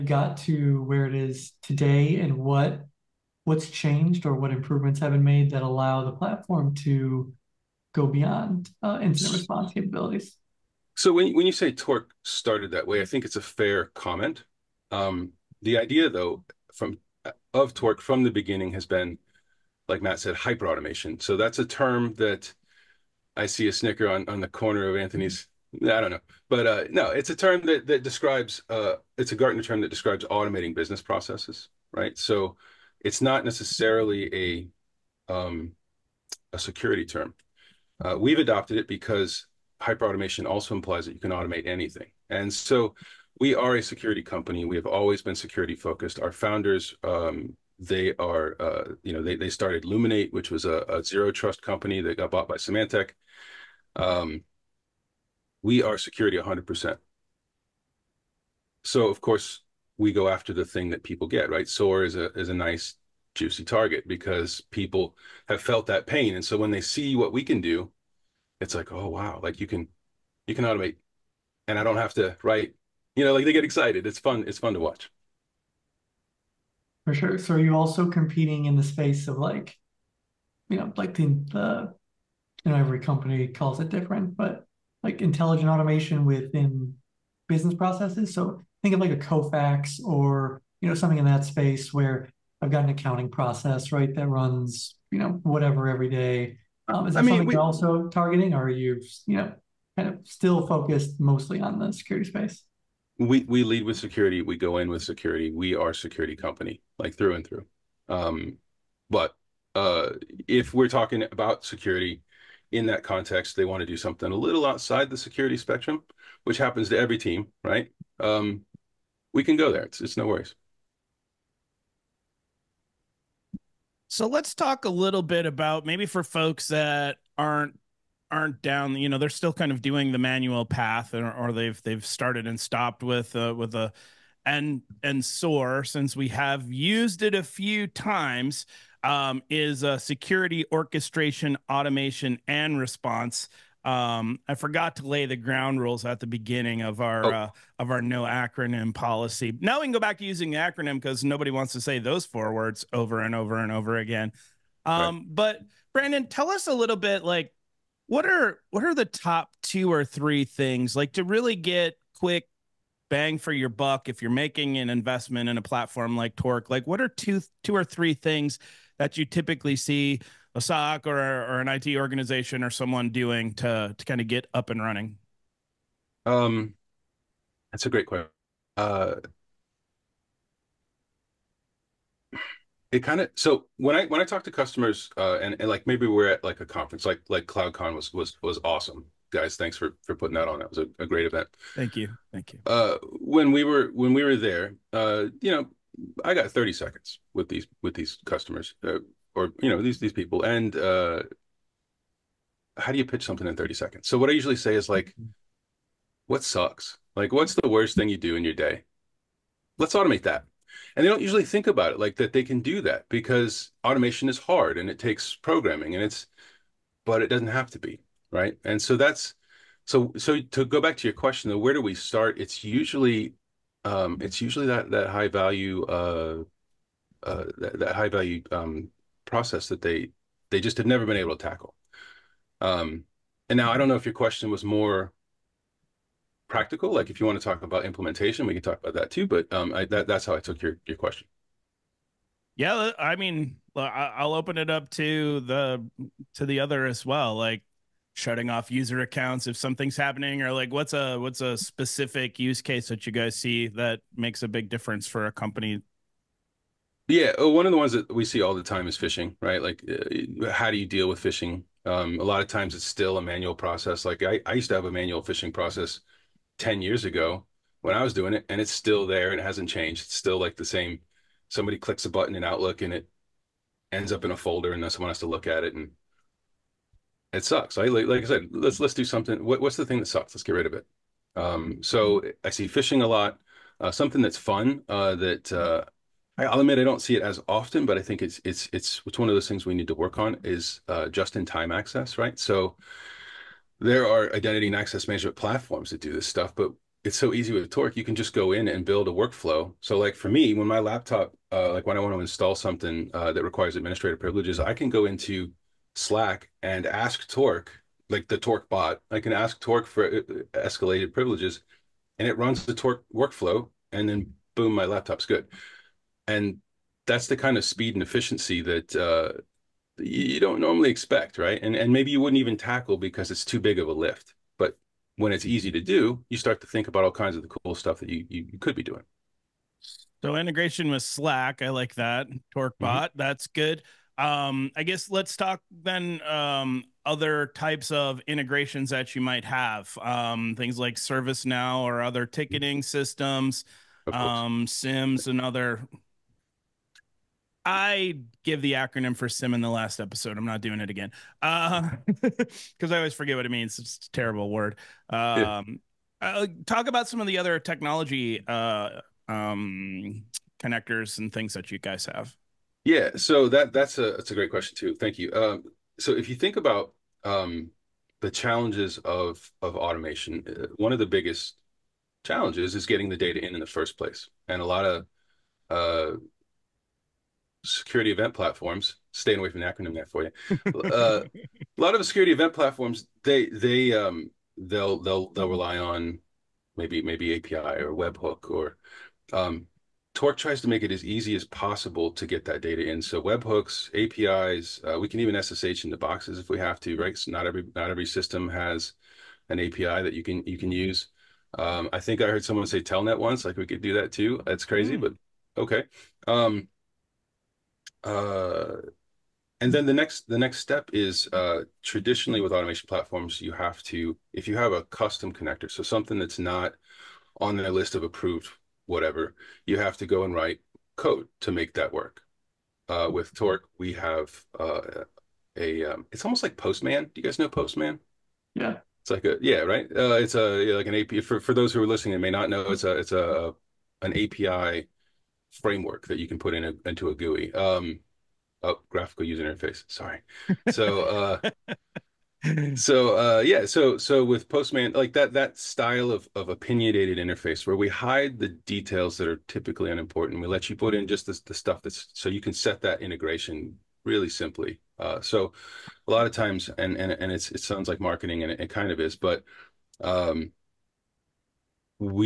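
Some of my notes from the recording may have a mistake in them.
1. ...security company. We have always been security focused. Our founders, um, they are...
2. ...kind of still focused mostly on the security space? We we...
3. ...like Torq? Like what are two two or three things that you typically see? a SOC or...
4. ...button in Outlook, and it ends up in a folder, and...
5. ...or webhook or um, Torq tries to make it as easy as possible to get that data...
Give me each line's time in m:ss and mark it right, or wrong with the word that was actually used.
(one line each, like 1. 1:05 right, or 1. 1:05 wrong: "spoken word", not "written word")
1. 0:43 right
2. 1:39 right
3. 2:46 right
4. 4:32 right
5. 6:27 right.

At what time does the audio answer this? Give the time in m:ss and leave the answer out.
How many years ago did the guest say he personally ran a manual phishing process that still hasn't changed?
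4:26.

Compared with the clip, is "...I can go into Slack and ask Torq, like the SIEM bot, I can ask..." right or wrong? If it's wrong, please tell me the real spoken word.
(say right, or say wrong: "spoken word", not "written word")
wrong: "Torq", not "SIEM".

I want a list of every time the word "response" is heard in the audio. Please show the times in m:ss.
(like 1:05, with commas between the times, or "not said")
0:09, 2:22.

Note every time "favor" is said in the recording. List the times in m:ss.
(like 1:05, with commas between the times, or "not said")
not said.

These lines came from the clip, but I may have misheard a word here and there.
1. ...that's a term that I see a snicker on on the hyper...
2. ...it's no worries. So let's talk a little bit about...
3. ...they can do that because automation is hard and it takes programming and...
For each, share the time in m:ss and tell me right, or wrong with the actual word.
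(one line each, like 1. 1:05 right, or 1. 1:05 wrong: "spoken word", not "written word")
1. 0:21 wrong: "corner", not "hyper"
2. 2:00 right
3. 3:32 right.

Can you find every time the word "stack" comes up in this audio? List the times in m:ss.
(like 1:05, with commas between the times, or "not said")
not said.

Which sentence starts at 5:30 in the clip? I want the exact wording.
So integration with Slack, I like that.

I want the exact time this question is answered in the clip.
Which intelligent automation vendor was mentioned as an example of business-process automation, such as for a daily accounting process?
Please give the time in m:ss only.
1:29.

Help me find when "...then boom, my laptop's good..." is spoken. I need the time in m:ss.
5:14.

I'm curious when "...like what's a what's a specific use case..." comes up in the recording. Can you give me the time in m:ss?
4:10.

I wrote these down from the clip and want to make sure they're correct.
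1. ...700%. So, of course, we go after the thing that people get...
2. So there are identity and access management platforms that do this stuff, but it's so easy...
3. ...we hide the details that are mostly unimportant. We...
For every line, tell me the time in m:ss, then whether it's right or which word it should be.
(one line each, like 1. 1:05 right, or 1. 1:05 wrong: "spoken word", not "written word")
1. 0:56 wrong: "100", not "700"
2. 4:52 right
3. 7:27 wrong: "typically", not "mostly".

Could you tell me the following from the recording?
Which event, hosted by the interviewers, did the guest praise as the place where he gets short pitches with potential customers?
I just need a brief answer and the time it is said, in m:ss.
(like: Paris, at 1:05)
CloudCon, at 3:07.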